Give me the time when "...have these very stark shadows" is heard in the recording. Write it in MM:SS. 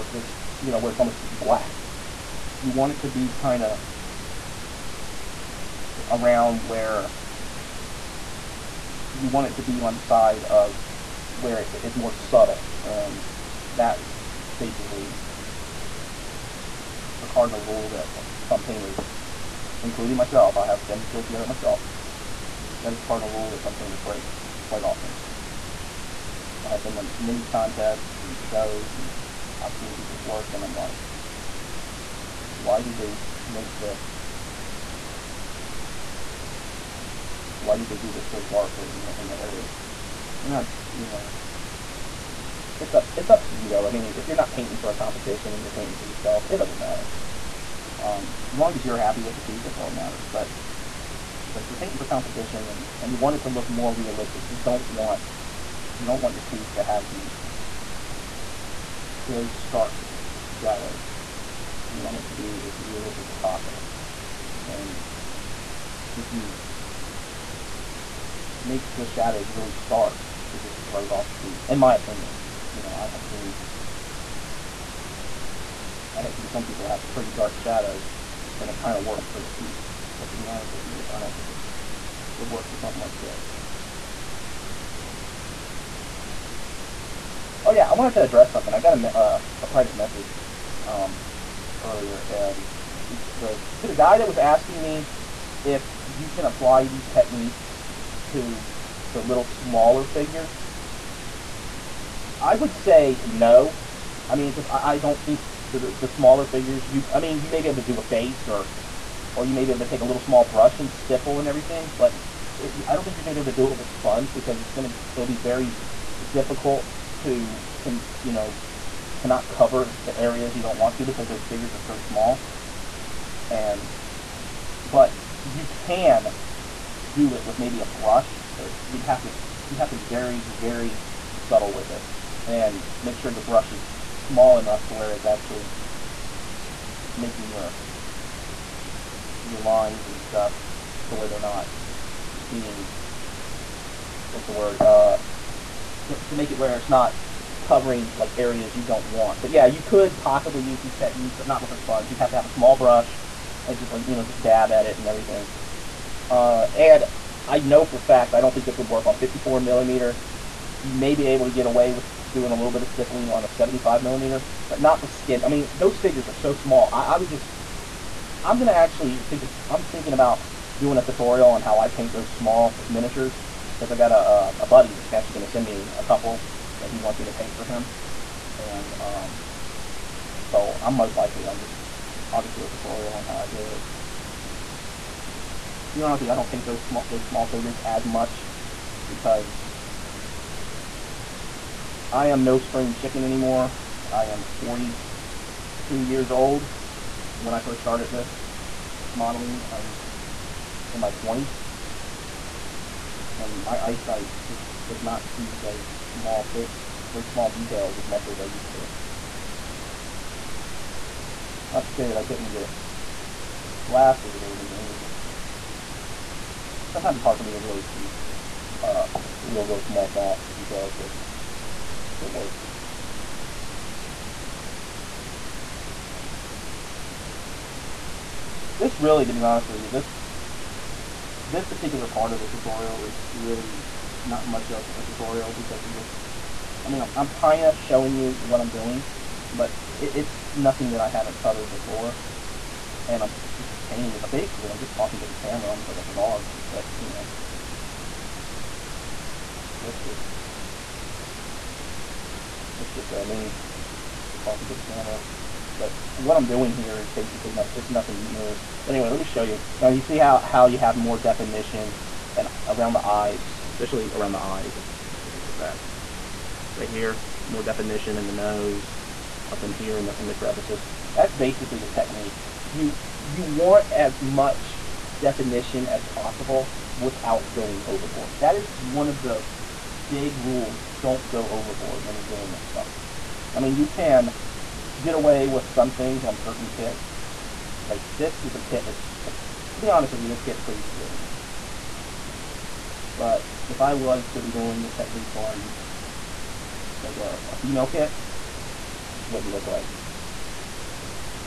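00:56.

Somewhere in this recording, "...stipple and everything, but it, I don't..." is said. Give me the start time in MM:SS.
01:50.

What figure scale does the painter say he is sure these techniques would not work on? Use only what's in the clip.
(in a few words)
54 millimeter.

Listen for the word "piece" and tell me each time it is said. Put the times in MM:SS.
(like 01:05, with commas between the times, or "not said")
00:49, 00:56, 01:11, 01:19.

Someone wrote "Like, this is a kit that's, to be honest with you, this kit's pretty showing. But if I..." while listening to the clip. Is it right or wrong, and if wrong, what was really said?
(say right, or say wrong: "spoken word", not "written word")
wrong: "forgiving", not "showing".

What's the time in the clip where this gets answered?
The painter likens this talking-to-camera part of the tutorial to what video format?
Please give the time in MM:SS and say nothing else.
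04:05.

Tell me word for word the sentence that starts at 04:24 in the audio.
Let's see if I can get back.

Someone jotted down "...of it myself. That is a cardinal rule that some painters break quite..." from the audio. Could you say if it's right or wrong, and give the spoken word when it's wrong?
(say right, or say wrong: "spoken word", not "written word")
right.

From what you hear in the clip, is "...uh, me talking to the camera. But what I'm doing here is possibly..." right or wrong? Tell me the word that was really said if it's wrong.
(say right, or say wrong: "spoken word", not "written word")
wrong: "basically", not "possibly".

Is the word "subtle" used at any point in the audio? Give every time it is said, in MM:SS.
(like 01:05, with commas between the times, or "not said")
00:12, 02:11.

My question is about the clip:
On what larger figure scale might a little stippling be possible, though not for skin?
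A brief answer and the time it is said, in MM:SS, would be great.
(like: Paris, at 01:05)
75 millimeter, at 02:43.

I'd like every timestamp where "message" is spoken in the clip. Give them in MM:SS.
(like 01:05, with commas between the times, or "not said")
01:29.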